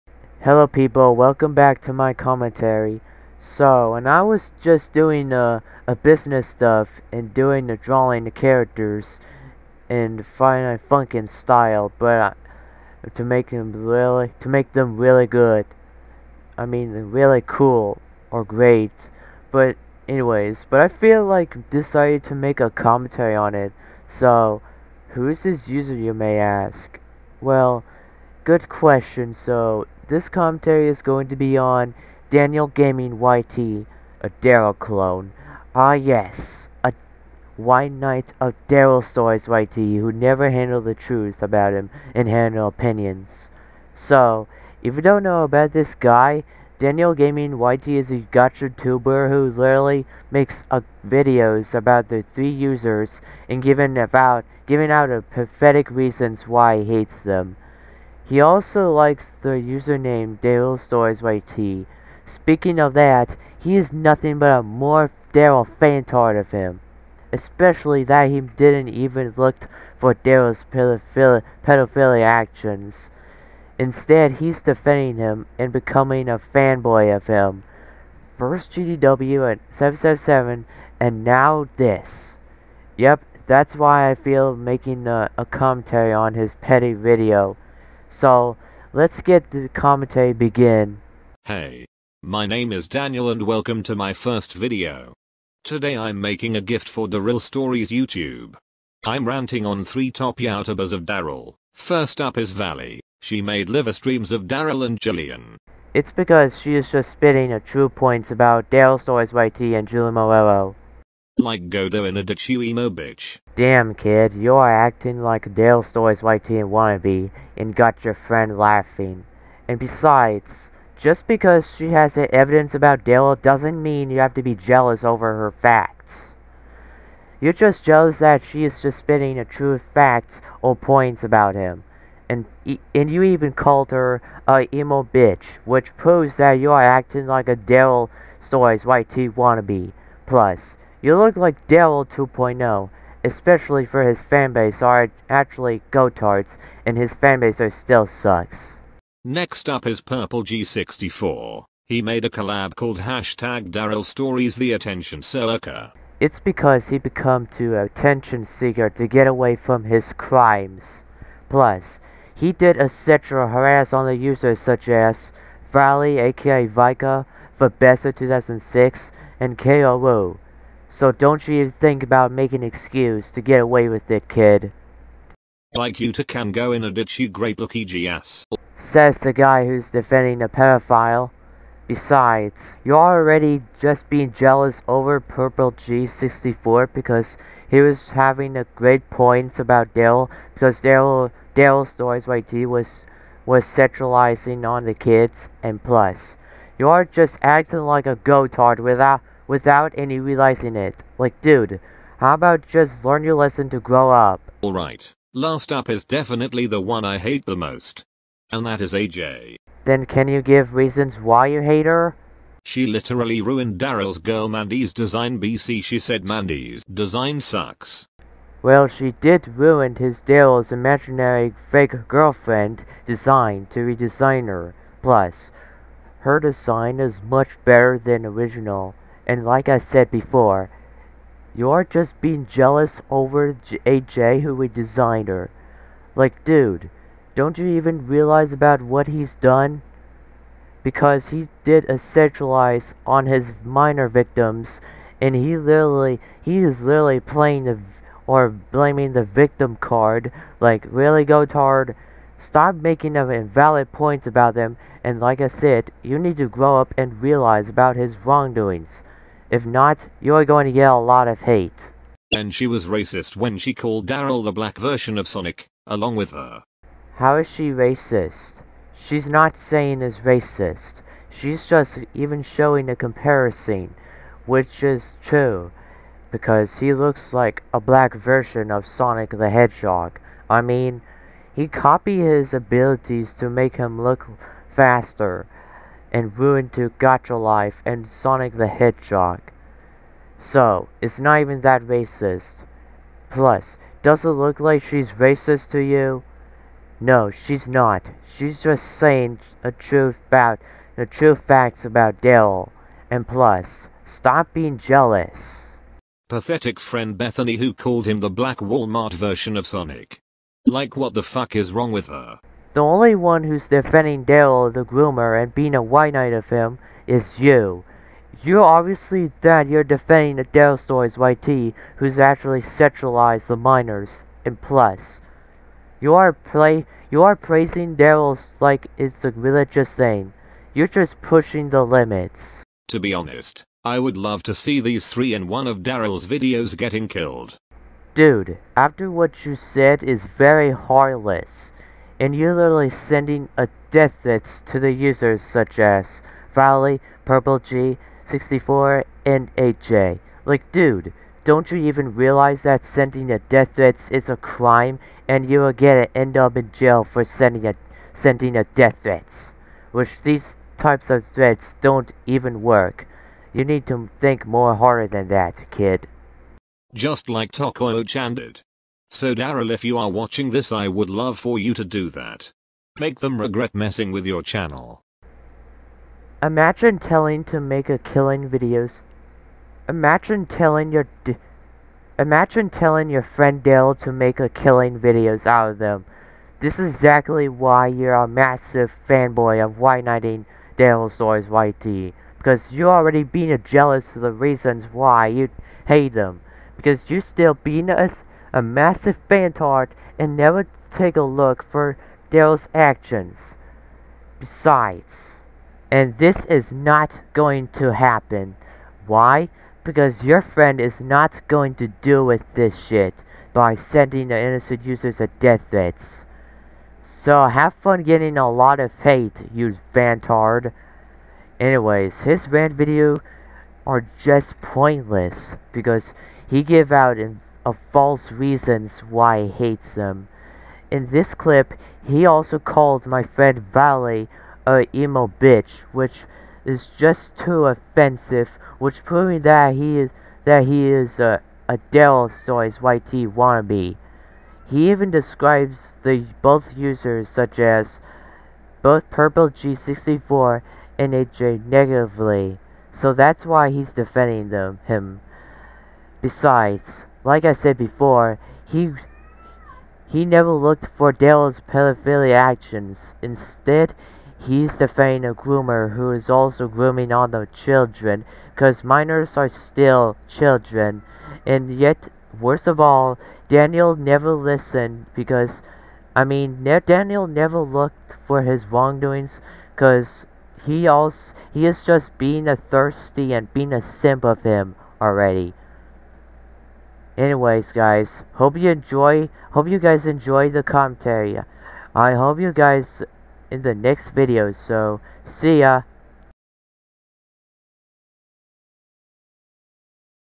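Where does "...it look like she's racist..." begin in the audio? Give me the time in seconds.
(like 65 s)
294 s.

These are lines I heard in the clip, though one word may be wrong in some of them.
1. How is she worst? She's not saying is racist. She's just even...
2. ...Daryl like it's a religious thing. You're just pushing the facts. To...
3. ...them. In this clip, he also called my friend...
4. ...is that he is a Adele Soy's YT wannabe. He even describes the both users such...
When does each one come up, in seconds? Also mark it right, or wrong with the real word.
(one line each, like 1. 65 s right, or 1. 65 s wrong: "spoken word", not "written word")
1. 267 s wrong: "racist", not "worst"
2. 327 s wrong: "limits", not "facts"
3. 429 s right
4. 439 s right.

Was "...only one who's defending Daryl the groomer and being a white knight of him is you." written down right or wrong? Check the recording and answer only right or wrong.
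right.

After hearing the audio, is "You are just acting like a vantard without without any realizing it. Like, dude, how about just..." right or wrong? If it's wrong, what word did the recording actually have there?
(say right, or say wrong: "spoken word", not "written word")
wrong: "gotard", not "vantard".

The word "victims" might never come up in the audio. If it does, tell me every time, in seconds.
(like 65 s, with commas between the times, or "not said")
244 s, 249 s.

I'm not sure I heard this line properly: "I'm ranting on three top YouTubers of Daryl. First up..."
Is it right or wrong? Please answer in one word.
right.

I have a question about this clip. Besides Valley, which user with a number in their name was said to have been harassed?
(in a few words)
Fabessa 2006.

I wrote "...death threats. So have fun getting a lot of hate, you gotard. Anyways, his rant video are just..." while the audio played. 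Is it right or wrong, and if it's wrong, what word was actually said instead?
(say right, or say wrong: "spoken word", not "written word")
wrong: "vantard", not "gotard".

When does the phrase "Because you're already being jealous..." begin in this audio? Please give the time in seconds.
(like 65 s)
392 s.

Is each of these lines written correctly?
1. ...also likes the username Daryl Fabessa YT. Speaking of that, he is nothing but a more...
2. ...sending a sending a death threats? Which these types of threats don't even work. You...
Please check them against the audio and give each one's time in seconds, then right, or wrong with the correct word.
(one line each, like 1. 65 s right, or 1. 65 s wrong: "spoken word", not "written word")
1. 58 s wrong: "Stories", not "Fabessa"
2. 357 s right.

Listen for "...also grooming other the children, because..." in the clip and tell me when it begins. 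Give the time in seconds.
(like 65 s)
466 s.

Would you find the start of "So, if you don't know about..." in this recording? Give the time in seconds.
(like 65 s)
43 s.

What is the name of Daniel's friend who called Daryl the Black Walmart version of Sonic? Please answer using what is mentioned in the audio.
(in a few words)
Bethany.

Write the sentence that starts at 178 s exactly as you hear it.
Says the guy who's defending a pedophile.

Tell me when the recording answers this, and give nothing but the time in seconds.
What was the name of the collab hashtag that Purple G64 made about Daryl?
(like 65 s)
153 s.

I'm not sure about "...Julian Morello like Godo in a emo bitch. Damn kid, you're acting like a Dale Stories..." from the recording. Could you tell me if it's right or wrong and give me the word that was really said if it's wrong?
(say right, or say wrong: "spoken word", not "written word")
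right.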